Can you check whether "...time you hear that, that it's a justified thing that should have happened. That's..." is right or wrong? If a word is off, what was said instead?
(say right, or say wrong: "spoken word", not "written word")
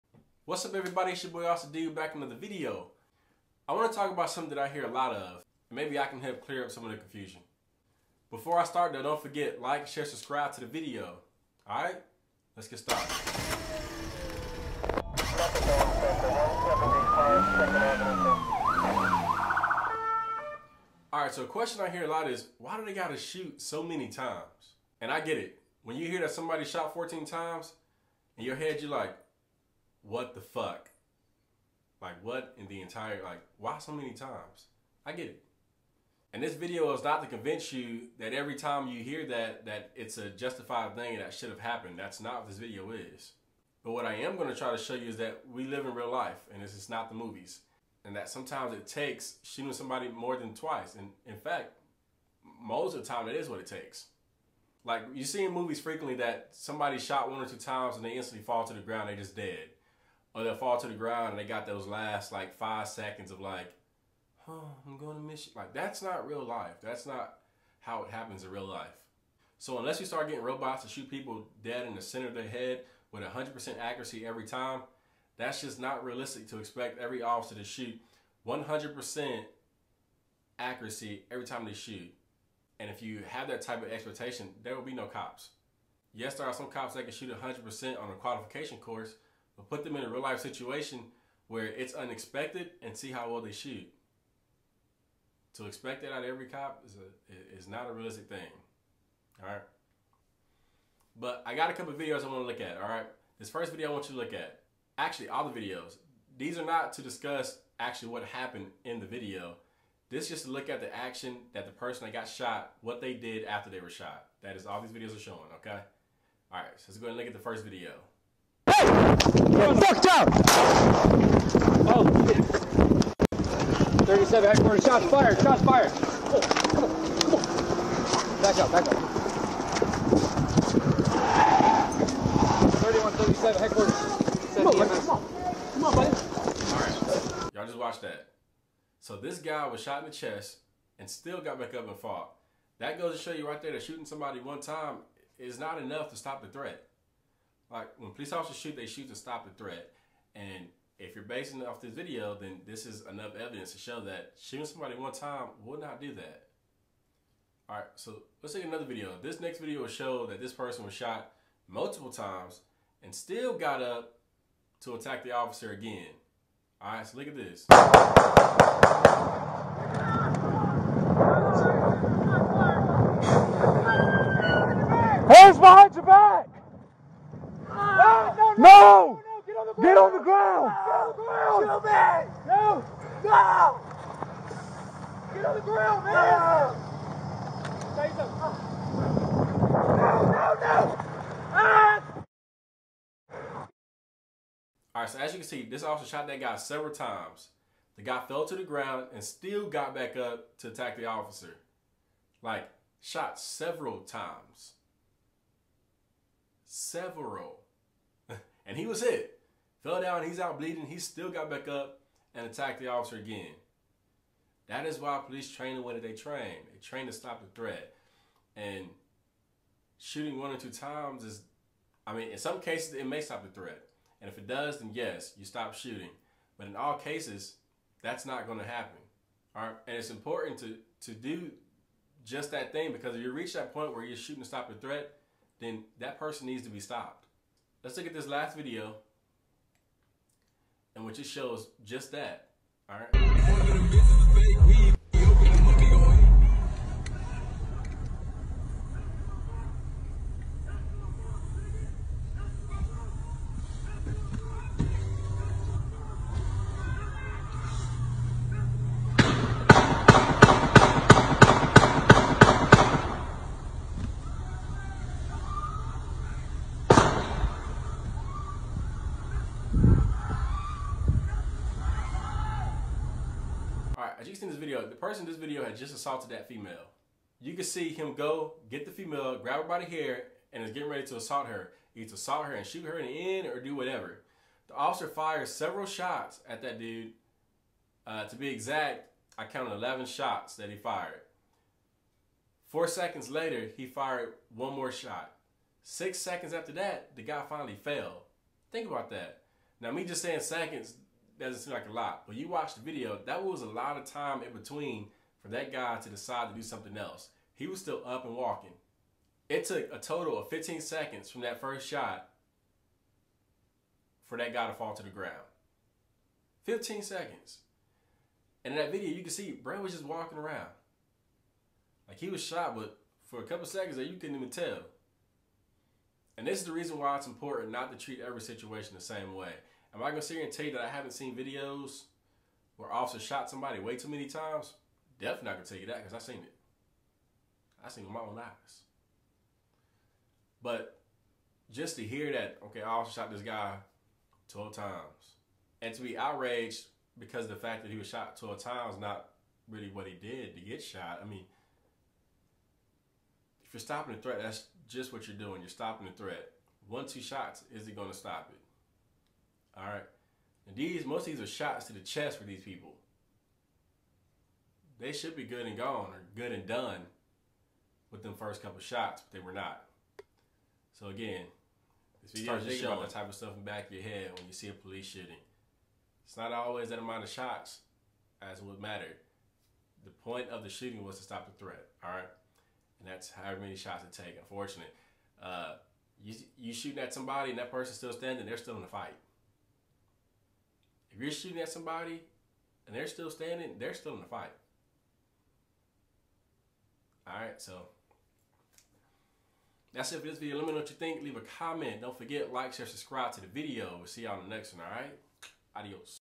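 right.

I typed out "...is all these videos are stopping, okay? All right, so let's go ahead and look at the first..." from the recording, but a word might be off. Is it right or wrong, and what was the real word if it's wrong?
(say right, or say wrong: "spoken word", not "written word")
wrong: "showing", not "stopping".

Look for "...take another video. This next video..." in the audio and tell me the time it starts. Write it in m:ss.
2:38.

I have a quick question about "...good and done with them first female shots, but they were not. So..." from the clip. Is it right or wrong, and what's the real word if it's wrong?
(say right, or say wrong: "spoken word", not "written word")
wrong: "couple", not "female".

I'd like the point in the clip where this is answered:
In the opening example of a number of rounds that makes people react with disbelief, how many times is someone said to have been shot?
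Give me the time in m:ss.
0:26.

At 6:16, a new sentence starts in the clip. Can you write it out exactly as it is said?
It's not always that amount of shots as would matter.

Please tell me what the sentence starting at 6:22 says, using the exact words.
And that's how many shots it take, unfortunately.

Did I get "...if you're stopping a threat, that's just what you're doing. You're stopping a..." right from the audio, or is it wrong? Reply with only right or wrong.
right.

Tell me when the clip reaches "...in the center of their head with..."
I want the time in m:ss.
1:11.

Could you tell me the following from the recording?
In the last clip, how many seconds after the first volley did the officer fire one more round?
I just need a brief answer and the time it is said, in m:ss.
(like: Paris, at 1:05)
4, at 4:52.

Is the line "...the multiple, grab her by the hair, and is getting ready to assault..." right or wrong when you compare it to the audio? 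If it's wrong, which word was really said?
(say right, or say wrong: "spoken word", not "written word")
wrong: "female", not "multiple".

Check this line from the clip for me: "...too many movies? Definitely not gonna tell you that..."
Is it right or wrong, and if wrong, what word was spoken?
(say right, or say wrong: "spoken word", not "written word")
wrong: "times", not "movies".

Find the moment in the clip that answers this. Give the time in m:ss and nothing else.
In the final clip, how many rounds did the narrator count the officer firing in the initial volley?
4:49.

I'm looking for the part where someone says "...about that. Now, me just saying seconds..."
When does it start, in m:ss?
4:58.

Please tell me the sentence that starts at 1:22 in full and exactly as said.
And if you have that type of expectation, there will be no cops.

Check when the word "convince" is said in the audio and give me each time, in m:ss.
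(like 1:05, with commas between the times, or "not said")
0:37.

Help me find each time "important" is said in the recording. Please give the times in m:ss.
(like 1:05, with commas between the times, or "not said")
3:50, 5:27.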